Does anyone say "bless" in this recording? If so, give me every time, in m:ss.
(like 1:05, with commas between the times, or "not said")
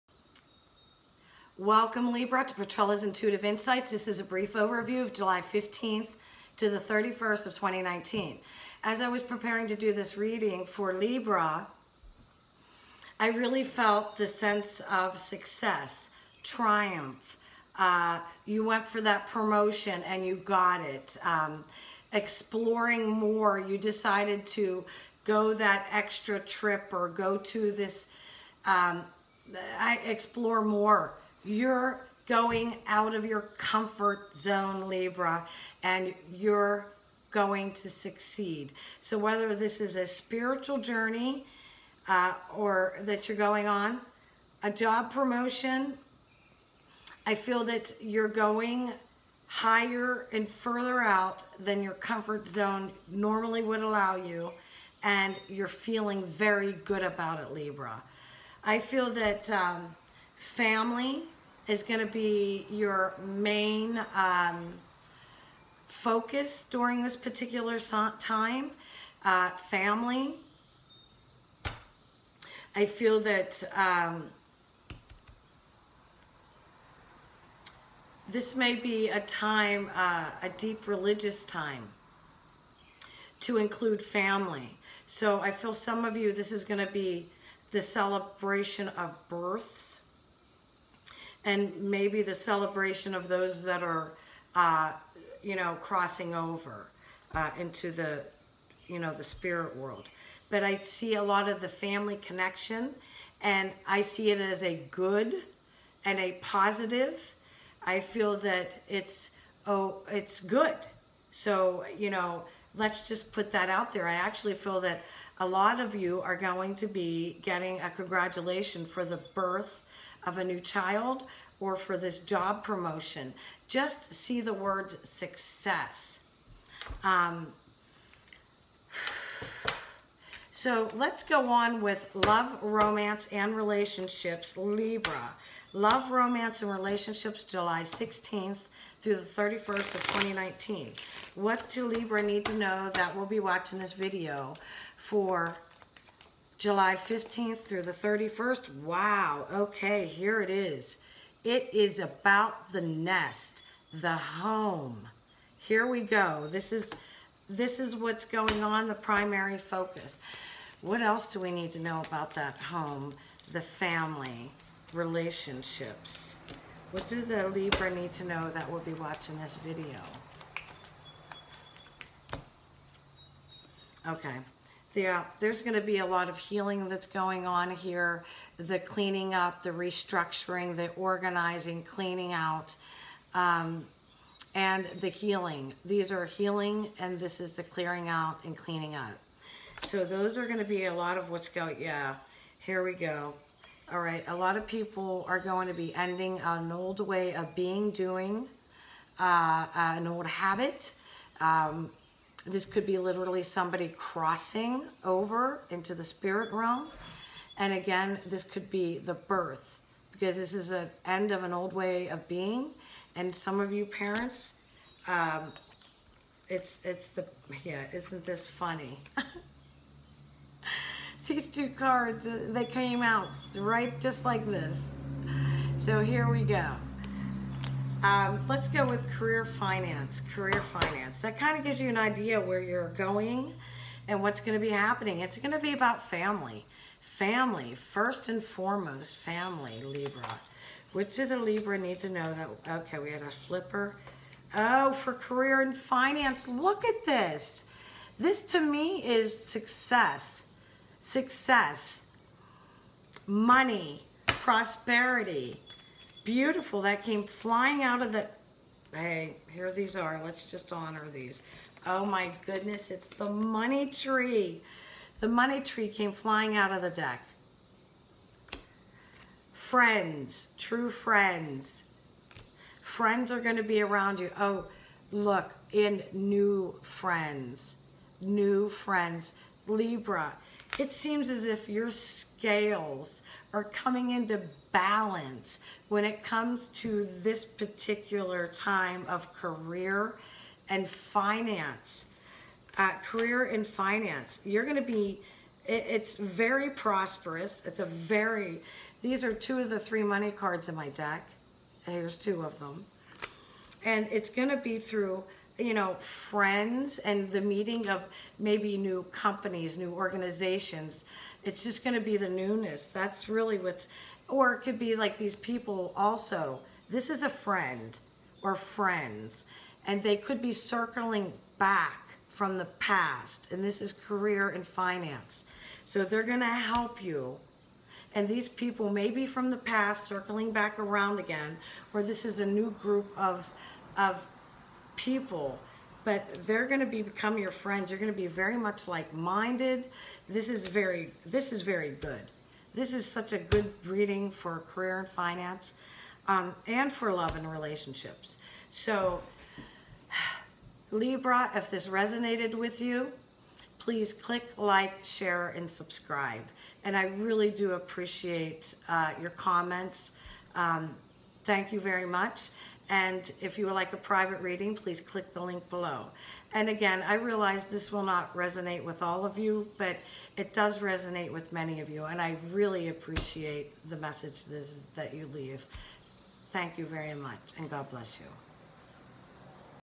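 6:17.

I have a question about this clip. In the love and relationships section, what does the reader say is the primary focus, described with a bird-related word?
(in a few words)
the nest.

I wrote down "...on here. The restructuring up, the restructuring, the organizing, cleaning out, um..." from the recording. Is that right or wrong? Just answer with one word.
wrong.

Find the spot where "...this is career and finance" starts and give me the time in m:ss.
5:23.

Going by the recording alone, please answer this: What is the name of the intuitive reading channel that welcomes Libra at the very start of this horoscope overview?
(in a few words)
Petrella's Intuitive Insights.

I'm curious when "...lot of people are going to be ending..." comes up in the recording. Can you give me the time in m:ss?
3:14.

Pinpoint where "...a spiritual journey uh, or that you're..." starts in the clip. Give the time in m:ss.
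0:39.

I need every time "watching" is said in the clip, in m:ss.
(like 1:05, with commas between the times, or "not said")
2:23, 2:48.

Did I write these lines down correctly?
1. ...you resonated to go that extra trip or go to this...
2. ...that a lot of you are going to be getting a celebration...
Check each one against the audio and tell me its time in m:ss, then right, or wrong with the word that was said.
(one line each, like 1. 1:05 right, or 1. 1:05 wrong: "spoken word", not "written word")
1. 0:23 wrong: "decided", not "resonated"
2. 1:54 wrong: "congratulation", not "celebration".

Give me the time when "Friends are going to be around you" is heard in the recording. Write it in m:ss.
4:32.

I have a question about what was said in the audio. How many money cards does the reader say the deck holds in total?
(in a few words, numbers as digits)
3.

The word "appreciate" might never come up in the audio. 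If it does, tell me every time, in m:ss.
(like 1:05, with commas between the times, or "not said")
5:57, 6:12.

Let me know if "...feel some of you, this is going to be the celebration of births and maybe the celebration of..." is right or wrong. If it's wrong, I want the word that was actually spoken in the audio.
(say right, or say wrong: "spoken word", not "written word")
right.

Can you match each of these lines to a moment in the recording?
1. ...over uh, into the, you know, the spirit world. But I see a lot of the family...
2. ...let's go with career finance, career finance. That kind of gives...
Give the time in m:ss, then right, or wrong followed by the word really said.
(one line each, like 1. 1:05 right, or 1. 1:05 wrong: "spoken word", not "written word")
1. 1:36 right
2. 3:48 right.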